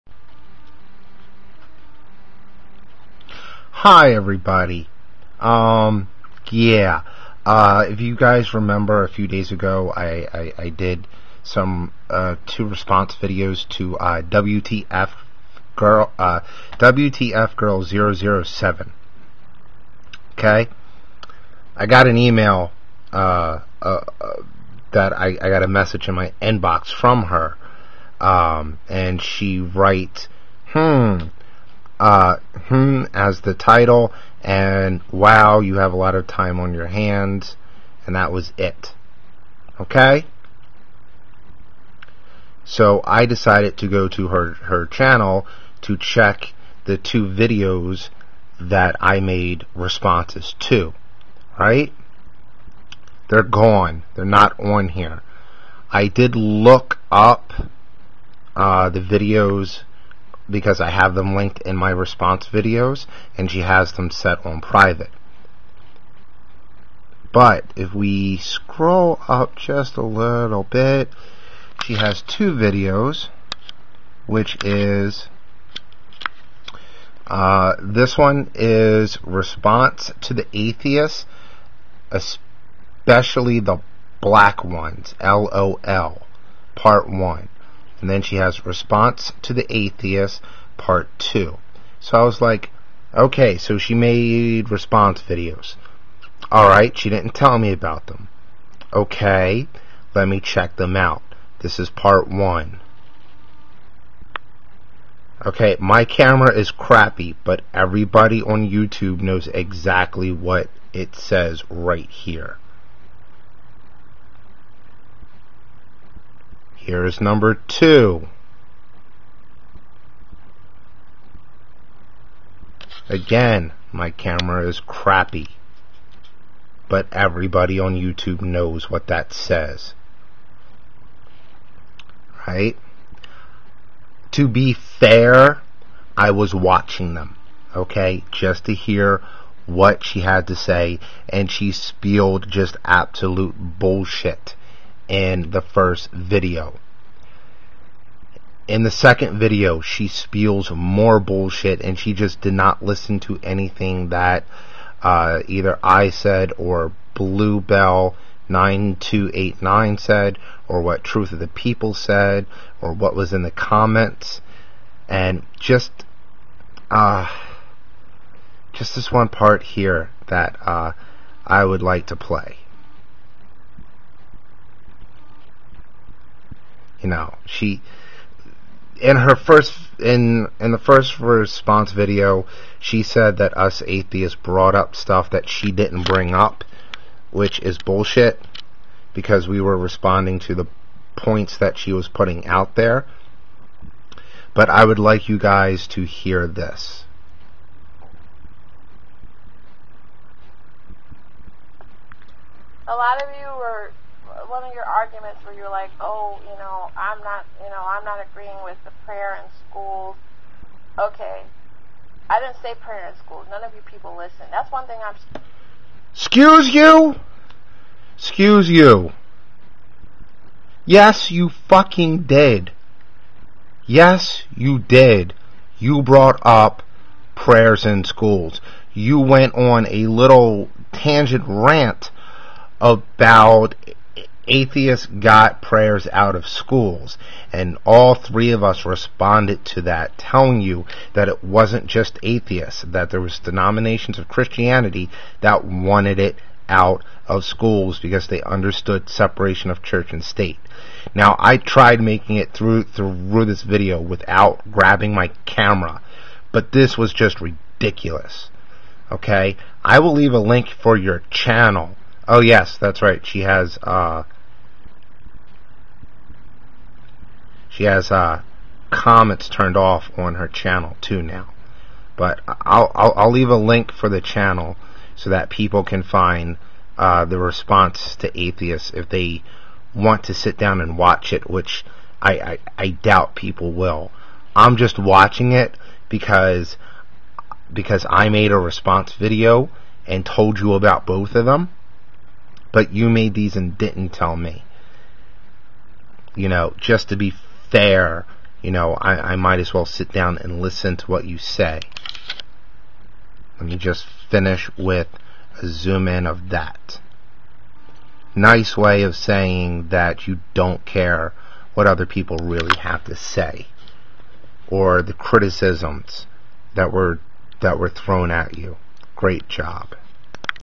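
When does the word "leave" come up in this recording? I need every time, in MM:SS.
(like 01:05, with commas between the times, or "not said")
04:20, 04:33.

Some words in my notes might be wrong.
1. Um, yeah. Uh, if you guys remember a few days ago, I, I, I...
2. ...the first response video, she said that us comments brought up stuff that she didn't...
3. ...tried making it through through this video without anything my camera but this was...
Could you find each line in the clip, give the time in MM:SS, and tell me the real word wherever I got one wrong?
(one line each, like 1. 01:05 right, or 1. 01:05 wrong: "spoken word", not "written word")
1. 00:05 right
2. 03:00 wrong: "atheists", not "comments"
3. 04:11 wrong: "grabbing", not "anything".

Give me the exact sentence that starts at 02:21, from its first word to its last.
And she spilled just absolute bullshit in the first video.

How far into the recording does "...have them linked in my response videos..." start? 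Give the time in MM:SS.
01:00.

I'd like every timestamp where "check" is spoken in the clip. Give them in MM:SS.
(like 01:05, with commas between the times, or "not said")
00:45, 01:40.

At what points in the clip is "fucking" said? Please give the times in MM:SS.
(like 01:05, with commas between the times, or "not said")
03:41.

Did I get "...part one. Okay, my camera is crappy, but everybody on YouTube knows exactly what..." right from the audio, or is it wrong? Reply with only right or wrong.
right.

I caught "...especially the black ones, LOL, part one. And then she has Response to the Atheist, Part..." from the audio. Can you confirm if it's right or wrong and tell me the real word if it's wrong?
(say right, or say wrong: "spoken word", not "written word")
right.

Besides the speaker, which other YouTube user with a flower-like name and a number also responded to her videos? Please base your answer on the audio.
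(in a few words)
Bluebell 9289.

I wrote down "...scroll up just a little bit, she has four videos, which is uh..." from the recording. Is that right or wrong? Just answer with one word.
wrong.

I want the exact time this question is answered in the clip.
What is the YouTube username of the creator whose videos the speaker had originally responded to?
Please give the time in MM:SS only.
00:16.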